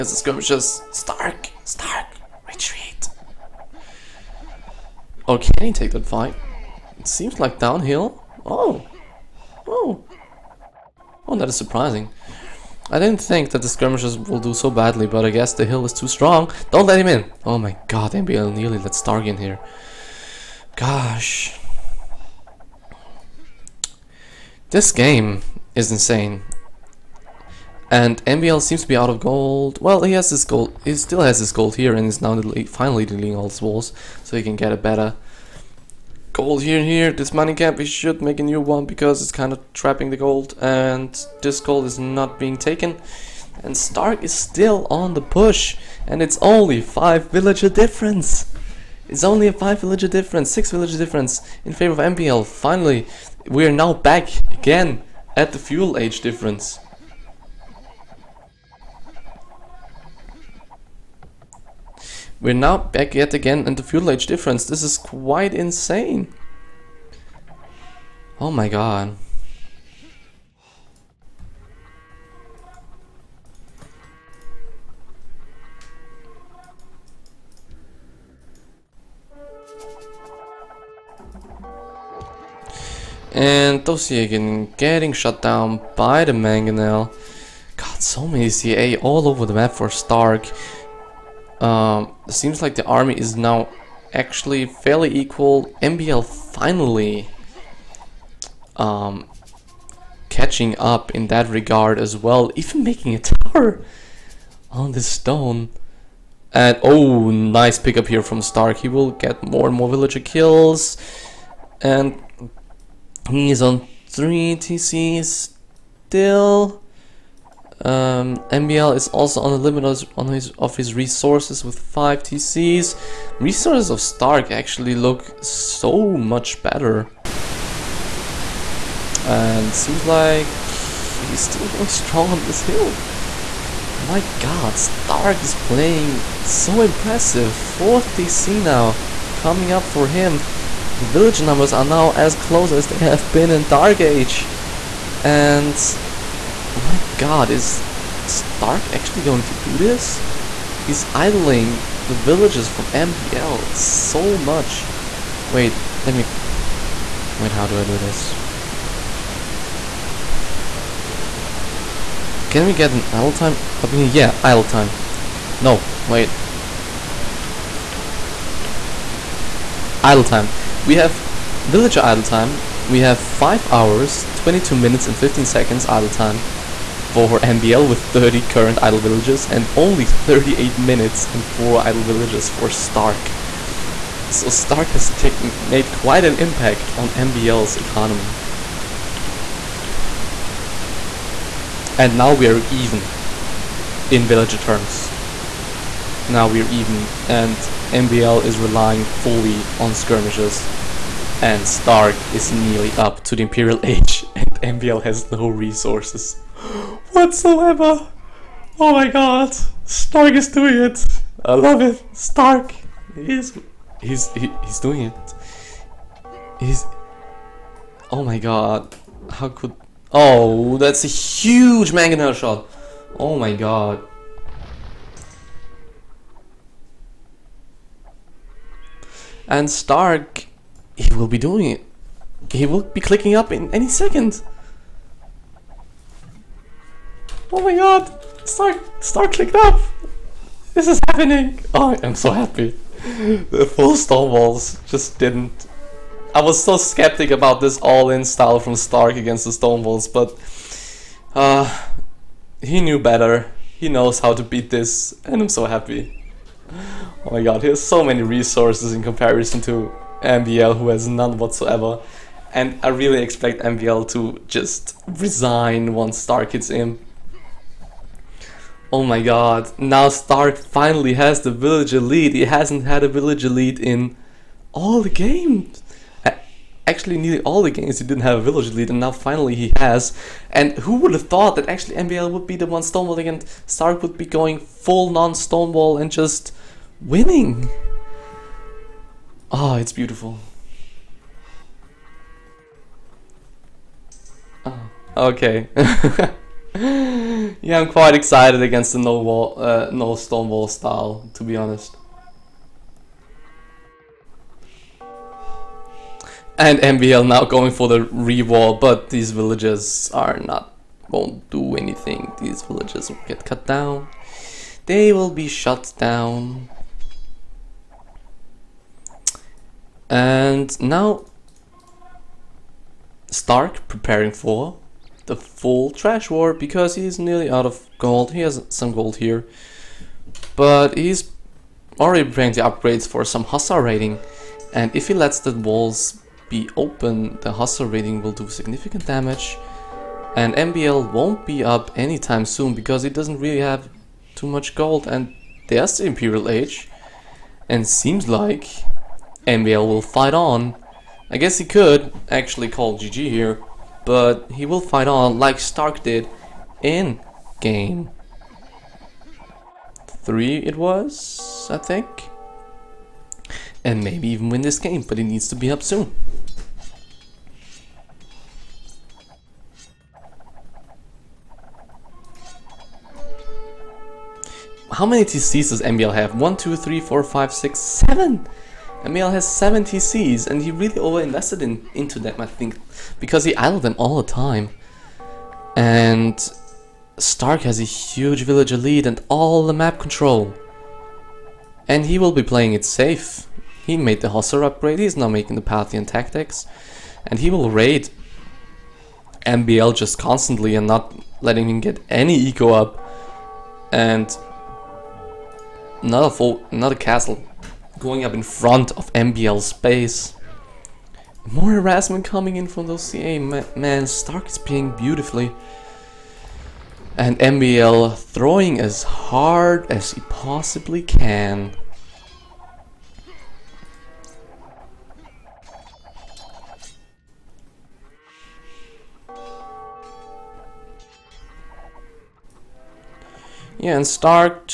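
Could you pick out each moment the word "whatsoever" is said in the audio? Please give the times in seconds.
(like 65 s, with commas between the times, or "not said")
207 s, 261 s.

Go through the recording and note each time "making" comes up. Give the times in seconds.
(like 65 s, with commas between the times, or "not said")
102 s, 395 s.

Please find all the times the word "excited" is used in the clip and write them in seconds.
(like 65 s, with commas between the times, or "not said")
298 s.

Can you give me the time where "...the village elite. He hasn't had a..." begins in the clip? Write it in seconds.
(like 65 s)
271 s.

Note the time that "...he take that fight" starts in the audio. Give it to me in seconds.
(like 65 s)
5 s.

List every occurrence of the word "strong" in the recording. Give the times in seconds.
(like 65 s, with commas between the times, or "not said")
16 s, 131 s.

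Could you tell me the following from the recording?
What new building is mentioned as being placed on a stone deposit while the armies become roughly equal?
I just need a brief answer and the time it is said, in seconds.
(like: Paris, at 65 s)
A tower, at 103 s.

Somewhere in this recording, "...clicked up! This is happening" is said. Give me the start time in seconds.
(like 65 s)
239 s.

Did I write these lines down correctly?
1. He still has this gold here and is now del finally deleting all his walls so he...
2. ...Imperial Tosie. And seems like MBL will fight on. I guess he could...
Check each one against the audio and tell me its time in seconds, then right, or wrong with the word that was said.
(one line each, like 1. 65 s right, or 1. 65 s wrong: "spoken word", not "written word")
1. 30 s right
2. 346 s wrong: "Age", not "Tosie".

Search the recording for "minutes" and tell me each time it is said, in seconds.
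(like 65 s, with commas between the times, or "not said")
174 s, 180 s.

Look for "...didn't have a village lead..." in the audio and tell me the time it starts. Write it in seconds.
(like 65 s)
278 s.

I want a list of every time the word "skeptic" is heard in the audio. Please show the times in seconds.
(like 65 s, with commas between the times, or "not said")
246 s.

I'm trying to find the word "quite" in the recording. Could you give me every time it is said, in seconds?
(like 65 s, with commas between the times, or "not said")
64 s, 185 s, 297 s.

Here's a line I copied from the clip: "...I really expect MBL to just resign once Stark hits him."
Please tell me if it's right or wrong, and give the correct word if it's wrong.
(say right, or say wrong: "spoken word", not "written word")
right.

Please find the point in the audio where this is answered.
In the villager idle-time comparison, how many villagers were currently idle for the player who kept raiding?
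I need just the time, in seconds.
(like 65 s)
181 s.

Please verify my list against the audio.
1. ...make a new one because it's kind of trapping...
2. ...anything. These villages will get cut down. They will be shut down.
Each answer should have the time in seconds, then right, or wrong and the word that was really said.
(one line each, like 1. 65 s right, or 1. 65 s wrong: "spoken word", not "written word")
1. 38 s right
2. 311 s right.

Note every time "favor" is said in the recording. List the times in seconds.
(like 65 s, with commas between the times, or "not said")
51 s.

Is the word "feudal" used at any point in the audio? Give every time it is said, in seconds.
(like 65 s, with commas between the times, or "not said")
55 s, 63 s.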